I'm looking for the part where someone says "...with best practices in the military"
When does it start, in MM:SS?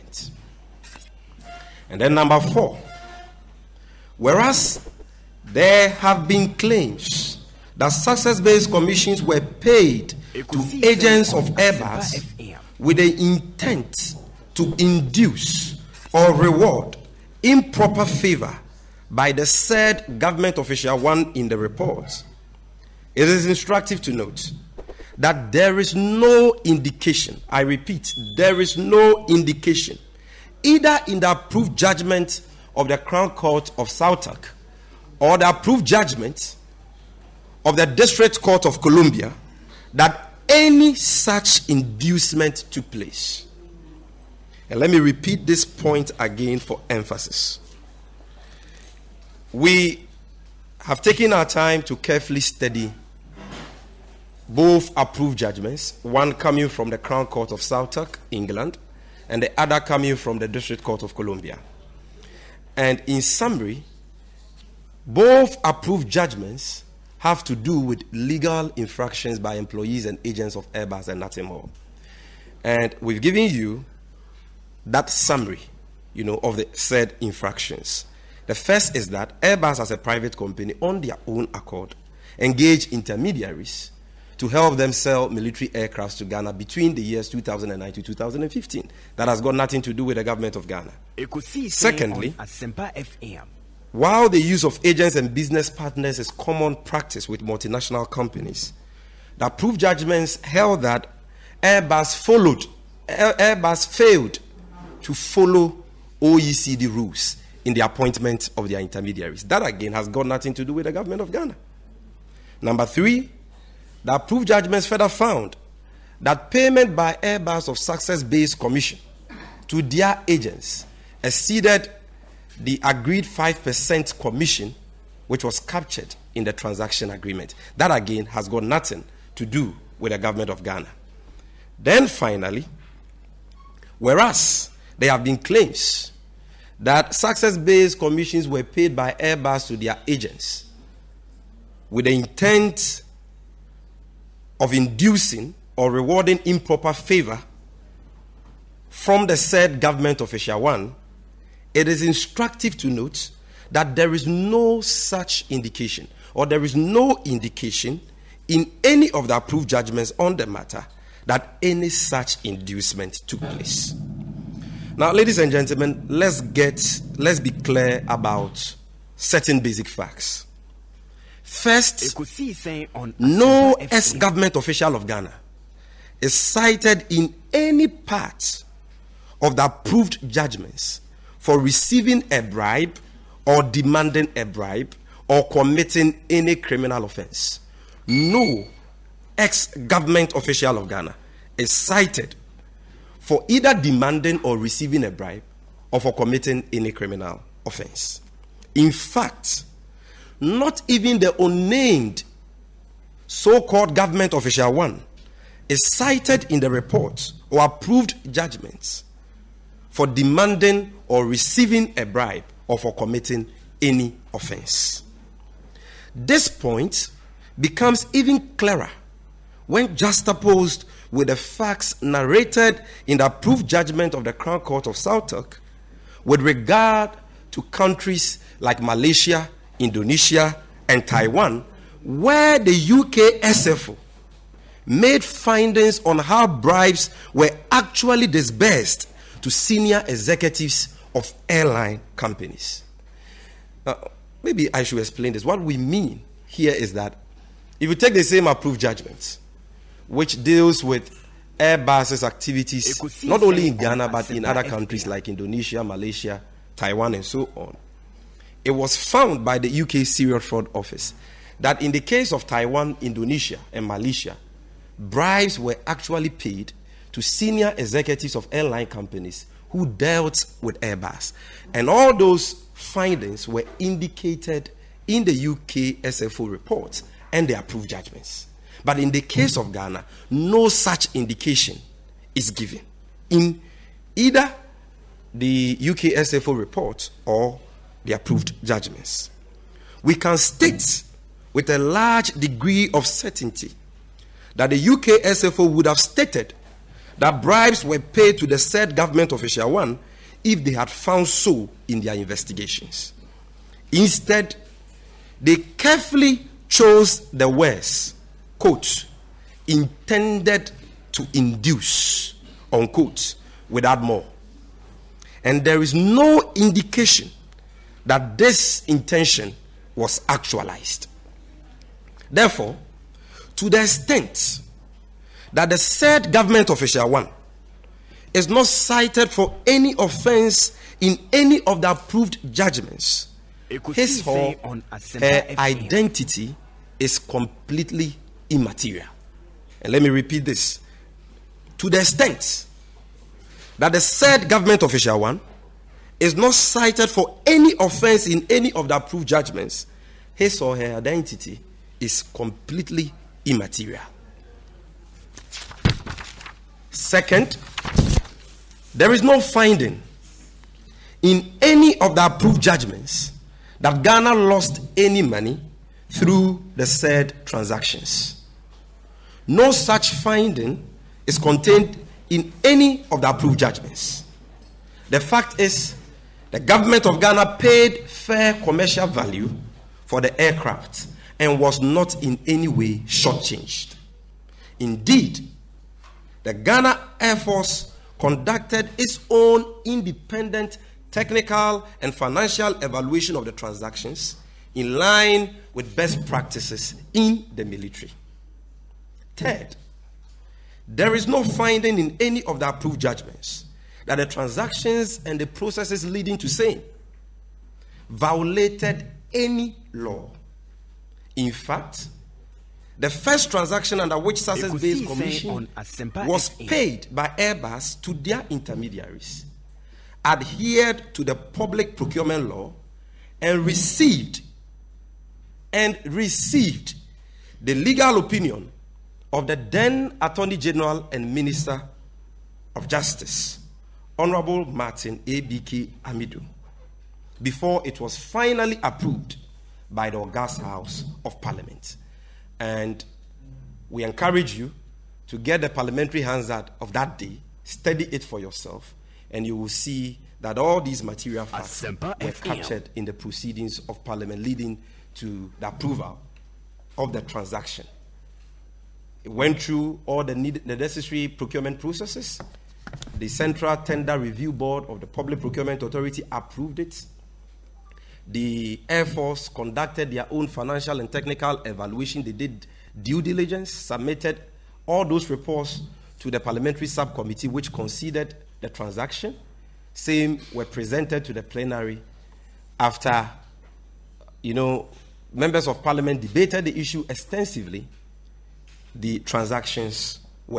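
06:35.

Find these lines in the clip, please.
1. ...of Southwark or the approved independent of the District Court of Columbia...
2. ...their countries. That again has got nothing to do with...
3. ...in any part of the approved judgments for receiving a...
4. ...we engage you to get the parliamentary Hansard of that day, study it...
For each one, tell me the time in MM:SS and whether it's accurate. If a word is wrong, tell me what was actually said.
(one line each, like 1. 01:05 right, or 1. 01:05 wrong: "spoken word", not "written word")
1. 00:33 wrong: "judgment", not "independent"
2. 01:48 wrong: "intermediaries", not "countries"
3. 02:57 right
4. 07:23 wrong: "encourage", not "engage".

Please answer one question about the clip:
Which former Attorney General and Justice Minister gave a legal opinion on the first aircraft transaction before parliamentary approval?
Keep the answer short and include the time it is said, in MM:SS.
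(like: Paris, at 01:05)
Martin A.B.K. Amidu, at 07:14.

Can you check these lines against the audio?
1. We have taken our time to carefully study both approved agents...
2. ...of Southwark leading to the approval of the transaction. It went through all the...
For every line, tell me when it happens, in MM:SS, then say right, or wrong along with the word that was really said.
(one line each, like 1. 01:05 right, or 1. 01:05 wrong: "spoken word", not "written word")
1. 00:49 wrong: "judgments", not "agents"
2. 07:33 wrong: "Parliament", not "Southwark".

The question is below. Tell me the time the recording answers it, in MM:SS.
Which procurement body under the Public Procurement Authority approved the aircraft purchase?
07:43.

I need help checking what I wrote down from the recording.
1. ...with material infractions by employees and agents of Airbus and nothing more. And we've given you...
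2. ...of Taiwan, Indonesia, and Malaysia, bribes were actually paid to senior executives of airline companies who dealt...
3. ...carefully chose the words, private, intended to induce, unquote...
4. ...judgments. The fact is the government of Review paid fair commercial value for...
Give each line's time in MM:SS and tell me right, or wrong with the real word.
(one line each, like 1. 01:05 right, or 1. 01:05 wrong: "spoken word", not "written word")
1. 01:07 wrong: "legal", not "material"
2. 04:22 right
3. 05:05 wrong: "quote", not "private"
4. 06:13 wrong: "Ghana", not "Review".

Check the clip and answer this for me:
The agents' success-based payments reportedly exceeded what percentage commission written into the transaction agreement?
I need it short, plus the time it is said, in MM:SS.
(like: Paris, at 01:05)
5%, at 02:03.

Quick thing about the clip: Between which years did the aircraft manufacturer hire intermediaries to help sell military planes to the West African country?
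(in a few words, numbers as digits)
2009 to 2015.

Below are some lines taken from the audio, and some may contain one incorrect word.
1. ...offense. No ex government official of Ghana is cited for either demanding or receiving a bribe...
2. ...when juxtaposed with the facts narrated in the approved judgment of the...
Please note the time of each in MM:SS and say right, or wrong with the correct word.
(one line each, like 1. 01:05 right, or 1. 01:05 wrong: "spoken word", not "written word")
1. 03:07 right
2. 03:39 right.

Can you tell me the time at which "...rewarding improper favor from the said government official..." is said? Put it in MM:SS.
02:25.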